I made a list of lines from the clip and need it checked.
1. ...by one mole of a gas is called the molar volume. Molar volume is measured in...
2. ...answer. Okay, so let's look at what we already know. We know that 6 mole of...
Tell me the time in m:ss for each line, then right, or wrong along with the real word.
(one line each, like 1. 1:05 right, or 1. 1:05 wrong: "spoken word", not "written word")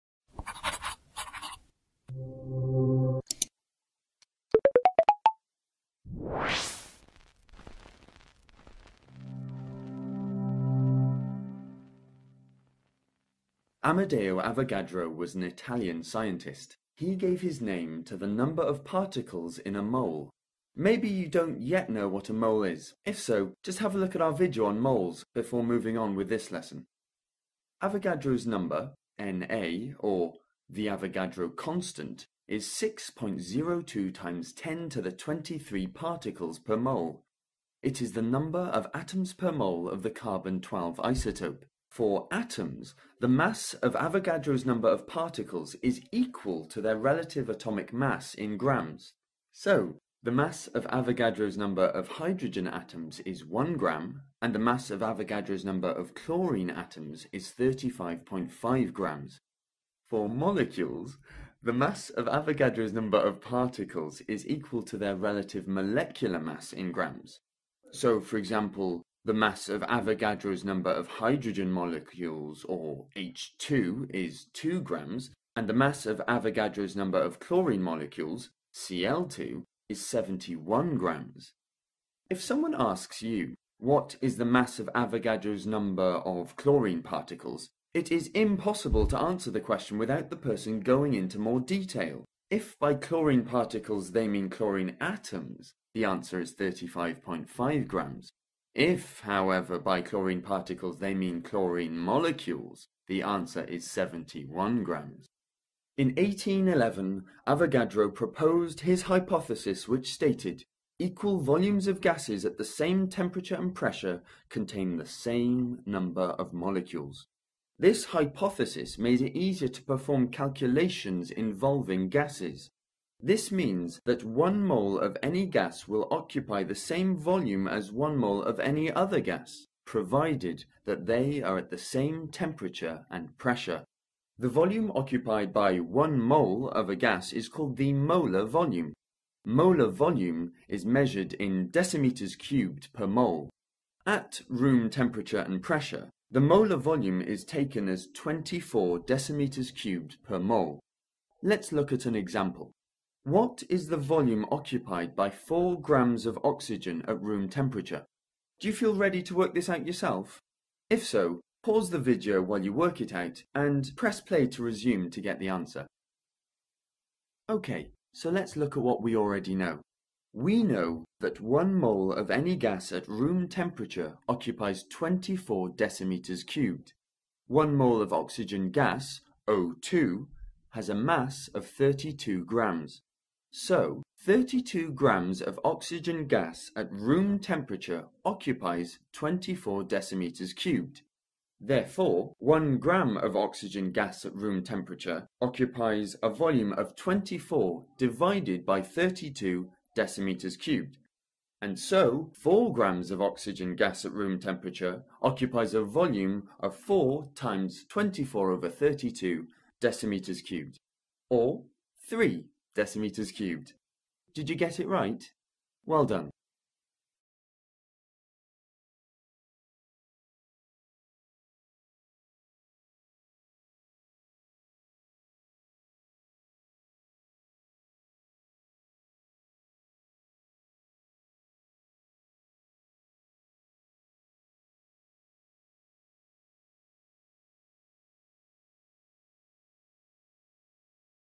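1. 2:15 right
2. 2:45 wrong: "1", not "6".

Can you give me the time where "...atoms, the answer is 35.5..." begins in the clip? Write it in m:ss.
1:34.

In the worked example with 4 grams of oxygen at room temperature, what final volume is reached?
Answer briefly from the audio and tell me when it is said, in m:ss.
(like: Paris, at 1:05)
3 decimeters cubed, at 3:32.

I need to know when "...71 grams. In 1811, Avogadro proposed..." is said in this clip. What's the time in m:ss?
1:43.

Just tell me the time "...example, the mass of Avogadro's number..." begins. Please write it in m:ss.
1:08.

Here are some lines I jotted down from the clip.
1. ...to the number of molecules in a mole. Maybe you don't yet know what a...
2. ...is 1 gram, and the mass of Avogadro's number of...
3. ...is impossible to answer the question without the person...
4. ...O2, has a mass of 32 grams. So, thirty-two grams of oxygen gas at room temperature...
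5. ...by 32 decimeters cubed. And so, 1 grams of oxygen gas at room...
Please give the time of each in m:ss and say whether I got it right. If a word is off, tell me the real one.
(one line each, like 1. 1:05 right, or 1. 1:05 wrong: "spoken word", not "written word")
1. 0:18 wrong: "particles", not "molecules"
2. 0:53 right
3. 1:28 right
4. 2:59 right
5. 3:18 wrong: "4", not "1".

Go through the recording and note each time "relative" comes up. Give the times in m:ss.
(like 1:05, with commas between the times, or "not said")
0:46, 1:05.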